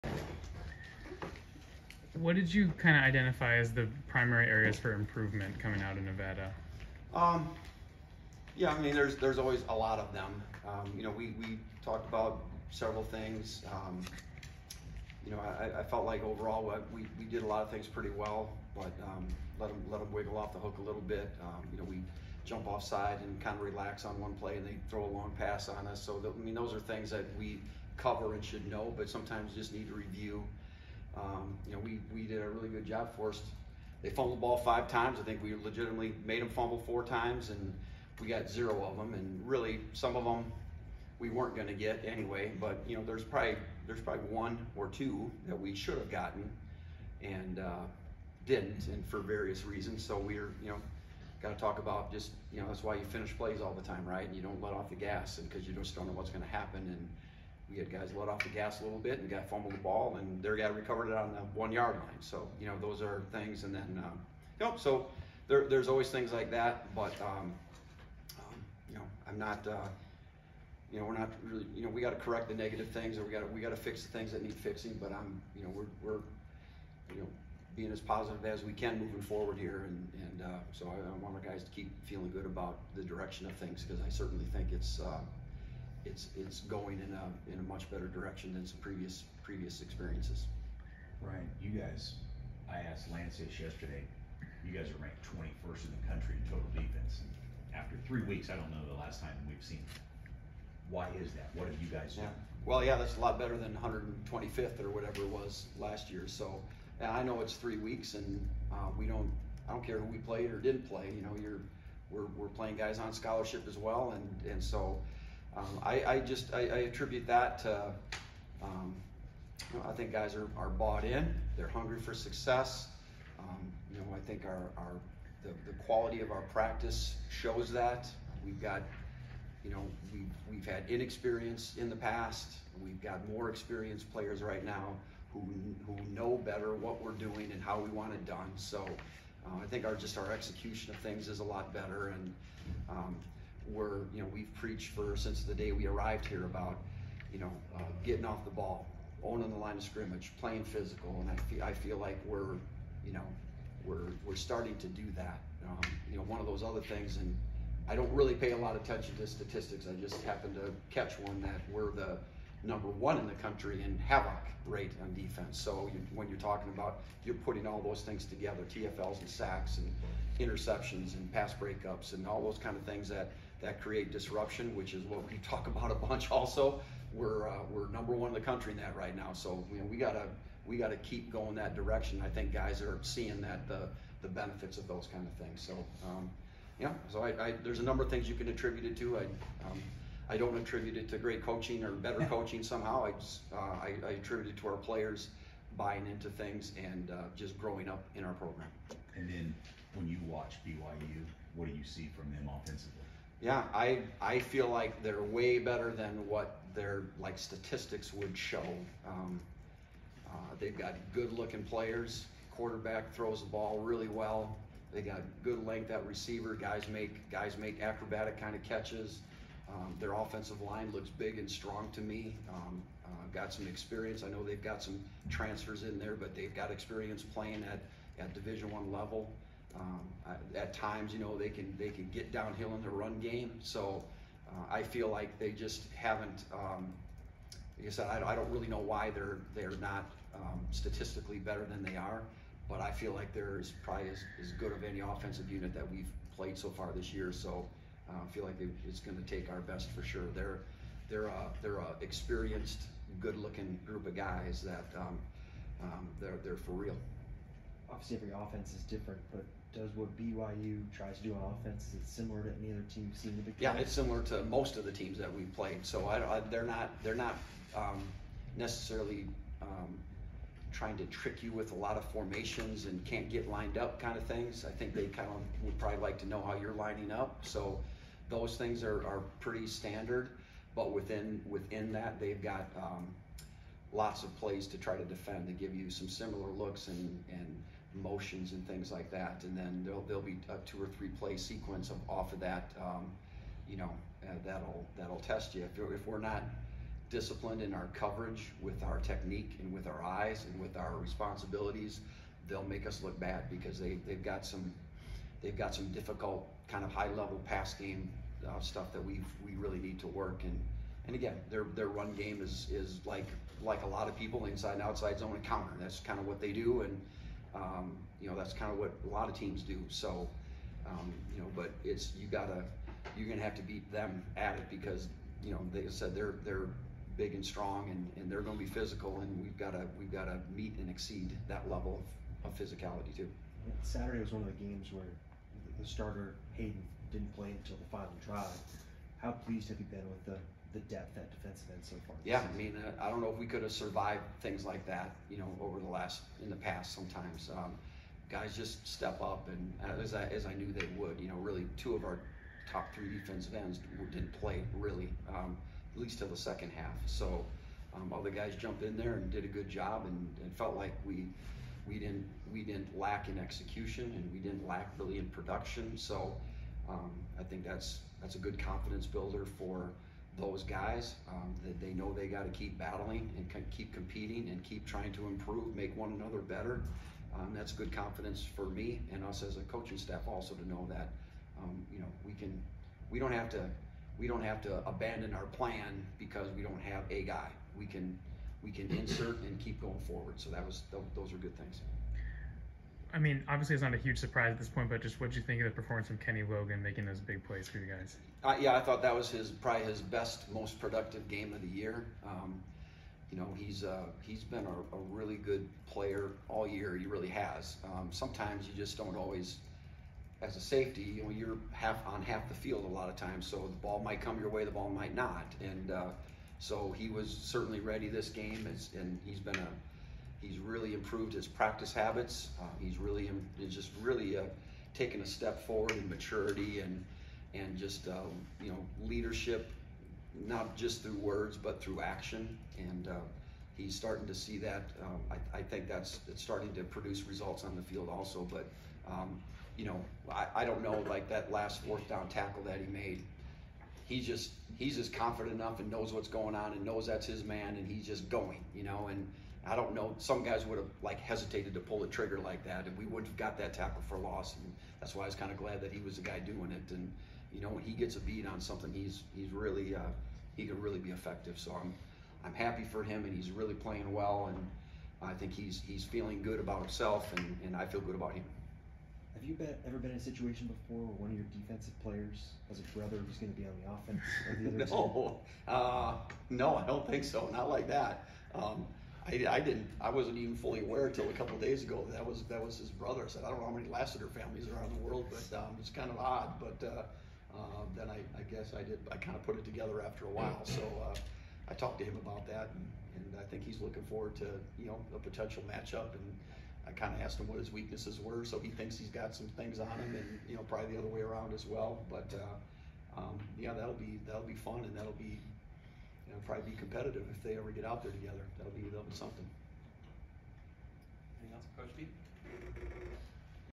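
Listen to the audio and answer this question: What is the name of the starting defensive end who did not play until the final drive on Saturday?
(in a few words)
Hayden.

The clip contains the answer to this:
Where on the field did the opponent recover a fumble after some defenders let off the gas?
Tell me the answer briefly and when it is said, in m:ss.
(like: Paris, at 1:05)
the one yard line, at 1:01.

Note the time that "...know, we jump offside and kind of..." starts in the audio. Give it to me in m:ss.
0:21.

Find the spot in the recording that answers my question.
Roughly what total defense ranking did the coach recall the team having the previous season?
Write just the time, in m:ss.
1:43.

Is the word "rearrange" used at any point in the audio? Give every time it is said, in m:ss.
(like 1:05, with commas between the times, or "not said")
not said.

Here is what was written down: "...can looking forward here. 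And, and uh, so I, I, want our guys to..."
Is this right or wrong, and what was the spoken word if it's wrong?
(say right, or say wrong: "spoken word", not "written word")
wrong: "moving", not "looking".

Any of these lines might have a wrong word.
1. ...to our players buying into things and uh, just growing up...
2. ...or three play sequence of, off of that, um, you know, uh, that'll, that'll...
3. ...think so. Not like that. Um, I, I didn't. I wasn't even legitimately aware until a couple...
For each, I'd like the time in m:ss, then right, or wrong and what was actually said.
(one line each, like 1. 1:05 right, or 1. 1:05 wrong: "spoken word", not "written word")
1. 3:14 right
2. 4:50 right
3. 7:57 wrong: "fully", not "legitimately".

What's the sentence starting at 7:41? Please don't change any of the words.
So I'm, I'm happy for him and he's really playing well.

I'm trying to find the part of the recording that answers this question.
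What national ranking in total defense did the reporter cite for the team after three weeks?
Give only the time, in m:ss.
1:35.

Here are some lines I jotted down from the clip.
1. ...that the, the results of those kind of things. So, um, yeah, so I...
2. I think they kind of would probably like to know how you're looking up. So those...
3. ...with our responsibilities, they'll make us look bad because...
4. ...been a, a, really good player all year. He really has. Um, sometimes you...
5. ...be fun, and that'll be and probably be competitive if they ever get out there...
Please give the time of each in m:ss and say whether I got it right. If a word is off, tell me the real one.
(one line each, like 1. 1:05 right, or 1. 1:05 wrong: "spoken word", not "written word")
1. 3:03 wrong: "benefits", not "results"
2. 4:34 wrong: "lining", not "looking"
3. 5:00 right
4. 6:44 right
5. 8:24 right.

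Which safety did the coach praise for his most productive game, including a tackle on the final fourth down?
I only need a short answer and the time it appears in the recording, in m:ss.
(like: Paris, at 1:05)
Kenny Logan, at 6:36.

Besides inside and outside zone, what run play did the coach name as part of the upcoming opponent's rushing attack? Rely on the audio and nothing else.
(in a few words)
Counter.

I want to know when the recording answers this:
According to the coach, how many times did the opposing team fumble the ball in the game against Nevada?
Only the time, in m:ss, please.
0:34.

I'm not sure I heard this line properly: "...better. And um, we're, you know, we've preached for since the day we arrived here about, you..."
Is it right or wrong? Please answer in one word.
right.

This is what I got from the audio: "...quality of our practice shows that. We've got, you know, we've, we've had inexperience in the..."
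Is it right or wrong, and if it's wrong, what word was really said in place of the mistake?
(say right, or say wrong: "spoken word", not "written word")
right.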